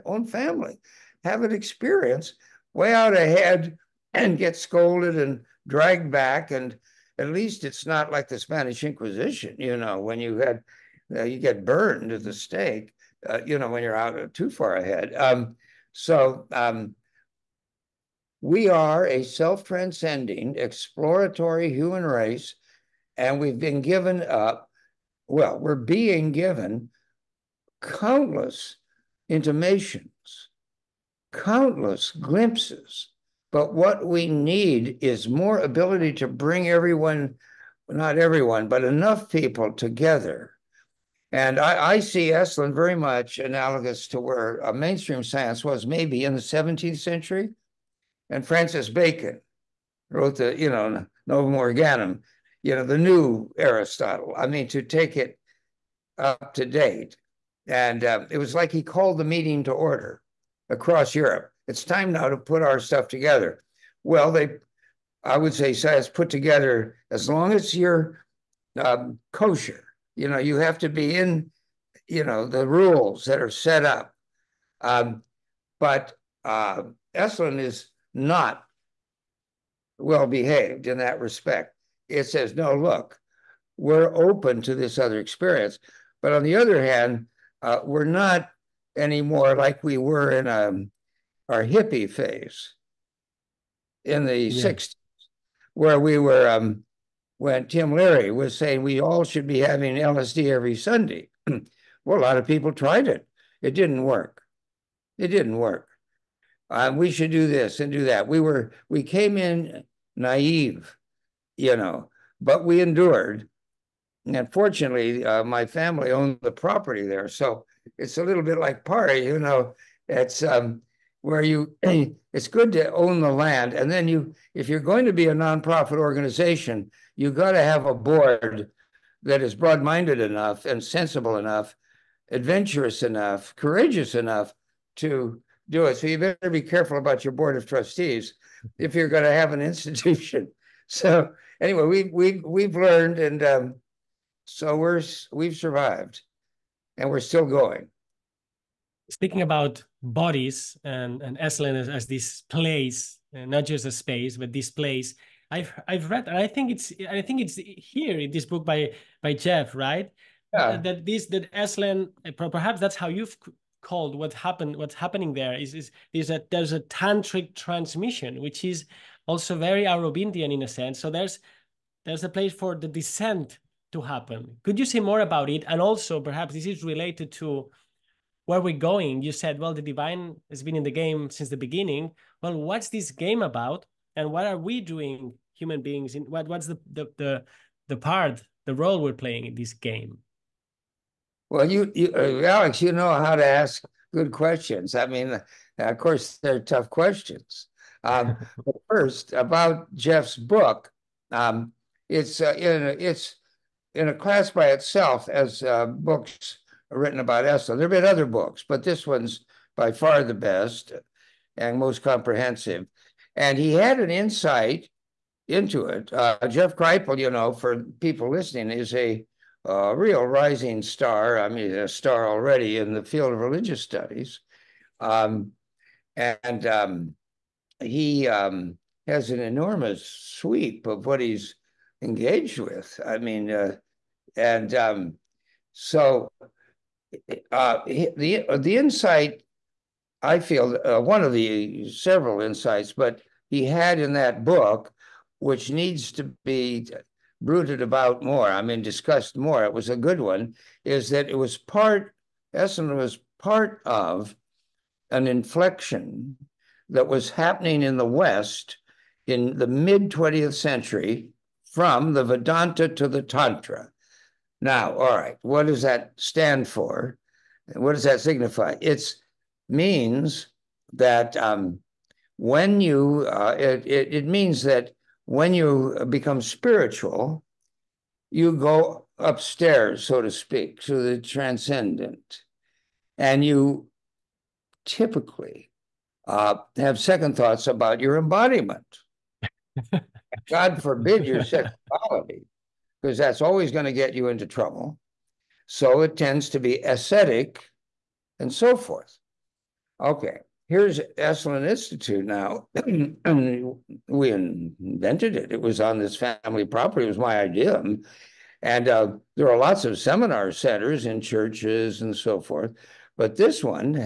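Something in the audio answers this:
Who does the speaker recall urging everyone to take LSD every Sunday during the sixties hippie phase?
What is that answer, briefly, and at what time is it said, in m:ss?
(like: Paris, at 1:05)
Tim Leary, at 1:37.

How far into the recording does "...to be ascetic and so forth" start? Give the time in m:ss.
4:56.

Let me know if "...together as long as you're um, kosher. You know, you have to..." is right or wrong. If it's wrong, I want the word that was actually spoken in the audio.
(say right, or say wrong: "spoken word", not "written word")
right.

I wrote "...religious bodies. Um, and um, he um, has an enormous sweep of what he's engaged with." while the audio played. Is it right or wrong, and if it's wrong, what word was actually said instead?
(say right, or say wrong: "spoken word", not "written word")
wrong: "studies", not "bodies".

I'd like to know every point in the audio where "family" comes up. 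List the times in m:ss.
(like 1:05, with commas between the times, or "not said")
0:00, 1:55, 5:06.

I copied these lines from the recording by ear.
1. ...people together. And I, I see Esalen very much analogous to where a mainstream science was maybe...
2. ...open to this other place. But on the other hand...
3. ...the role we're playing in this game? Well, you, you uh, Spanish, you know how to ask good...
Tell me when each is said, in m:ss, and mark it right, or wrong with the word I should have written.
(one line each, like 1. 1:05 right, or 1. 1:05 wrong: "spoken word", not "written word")
1. 0:39 right
2. 1:24 wrong: "experience", not "place"
3. 3:08 wrong: "Alex", not "Spanish".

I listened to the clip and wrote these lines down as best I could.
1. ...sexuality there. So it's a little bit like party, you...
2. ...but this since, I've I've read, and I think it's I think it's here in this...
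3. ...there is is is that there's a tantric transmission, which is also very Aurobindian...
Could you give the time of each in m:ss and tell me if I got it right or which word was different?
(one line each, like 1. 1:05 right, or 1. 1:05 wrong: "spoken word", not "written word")
1. 1:56 wrong: "property", not "sexuality"
2. 2:34 wrong: "place", not "since"
3. 2:45 right.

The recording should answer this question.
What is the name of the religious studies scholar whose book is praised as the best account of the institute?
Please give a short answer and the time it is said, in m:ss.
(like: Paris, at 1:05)
Jeff Kripal, at 3:36.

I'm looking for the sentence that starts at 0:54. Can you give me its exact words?
I mean, to take it up to date.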